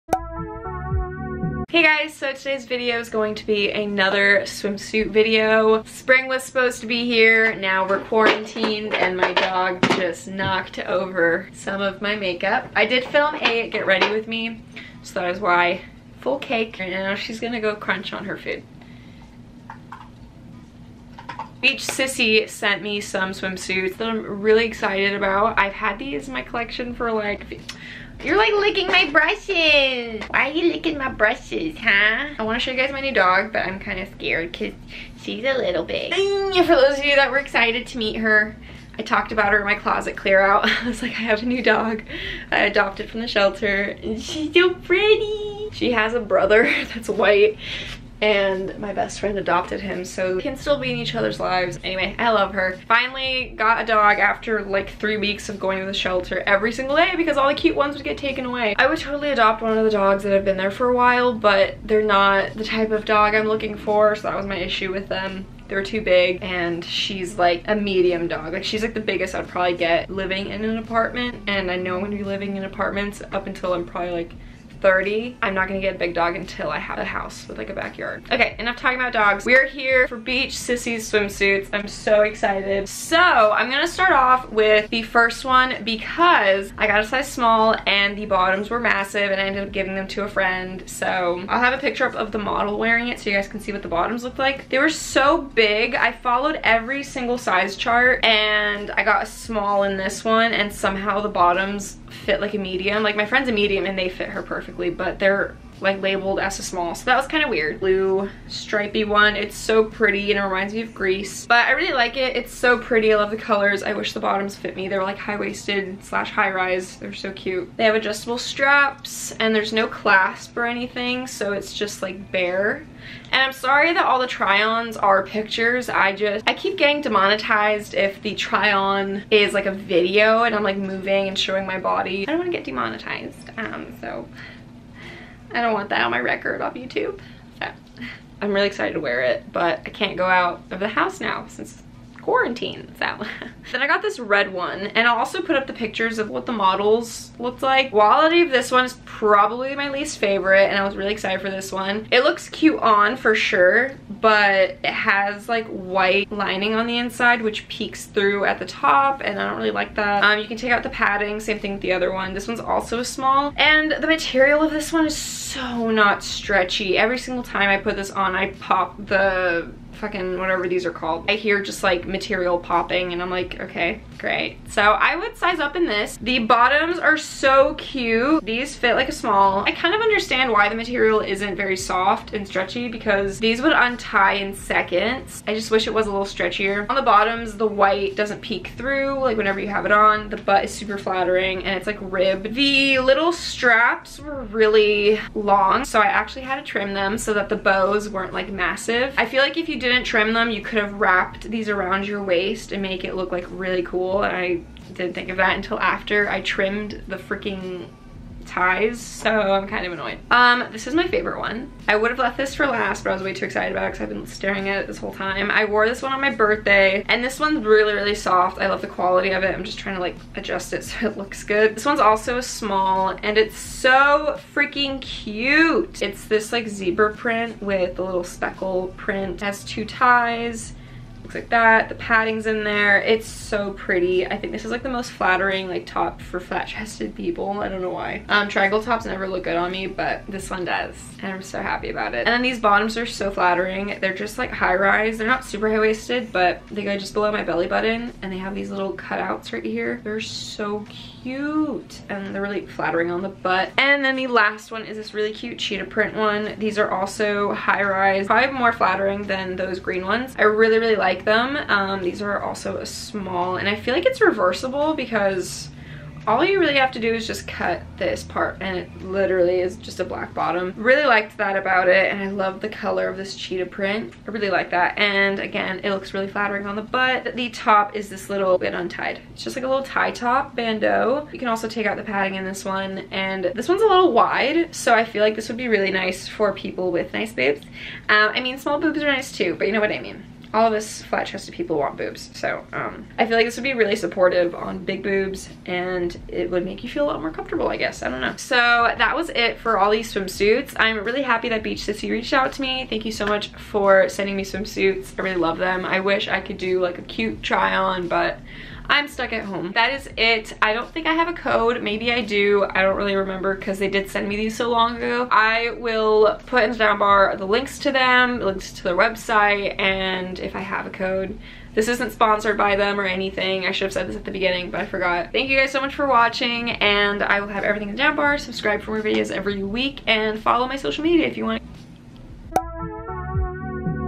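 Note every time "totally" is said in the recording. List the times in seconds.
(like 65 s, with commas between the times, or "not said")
58 s.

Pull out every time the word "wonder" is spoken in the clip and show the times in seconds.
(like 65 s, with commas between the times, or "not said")
not said.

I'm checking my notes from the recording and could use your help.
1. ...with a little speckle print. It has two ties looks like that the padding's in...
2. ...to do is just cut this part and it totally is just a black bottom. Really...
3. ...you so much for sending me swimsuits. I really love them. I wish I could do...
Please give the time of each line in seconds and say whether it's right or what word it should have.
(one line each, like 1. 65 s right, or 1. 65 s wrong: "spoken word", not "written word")
1. 227 s right
2. 266 s wrong: "literally", not "totally"
3. 303 s right.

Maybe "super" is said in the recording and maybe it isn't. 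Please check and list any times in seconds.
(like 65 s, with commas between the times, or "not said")
190 s, 245 s.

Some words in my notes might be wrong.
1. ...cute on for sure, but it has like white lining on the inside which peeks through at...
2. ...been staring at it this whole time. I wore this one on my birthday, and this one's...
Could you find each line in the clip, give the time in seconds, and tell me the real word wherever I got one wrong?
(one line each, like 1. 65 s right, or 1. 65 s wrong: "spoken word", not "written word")
1. 152 s right
2. 214 s right.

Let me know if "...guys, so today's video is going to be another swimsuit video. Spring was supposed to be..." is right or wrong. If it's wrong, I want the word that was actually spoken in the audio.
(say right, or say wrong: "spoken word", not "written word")
right.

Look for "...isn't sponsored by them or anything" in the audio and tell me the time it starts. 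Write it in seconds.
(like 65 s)
321 s.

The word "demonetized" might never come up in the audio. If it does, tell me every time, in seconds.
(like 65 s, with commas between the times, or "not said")
127 s, 132 s.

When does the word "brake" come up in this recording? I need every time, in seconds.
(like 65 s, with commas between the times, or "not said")
not said.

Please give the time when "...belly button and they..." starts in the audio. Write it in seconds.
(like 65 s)
247 s.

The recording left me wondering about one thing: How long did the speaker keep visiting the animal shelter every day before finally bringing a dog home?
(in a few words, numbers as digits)
3 weeks.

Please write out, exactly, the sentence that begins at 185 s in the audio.
I just wish it was a little stretchier.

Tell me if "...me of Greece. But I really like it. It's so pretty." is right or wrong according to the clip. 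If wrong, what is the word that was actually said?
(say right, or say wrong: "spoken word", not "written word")
right.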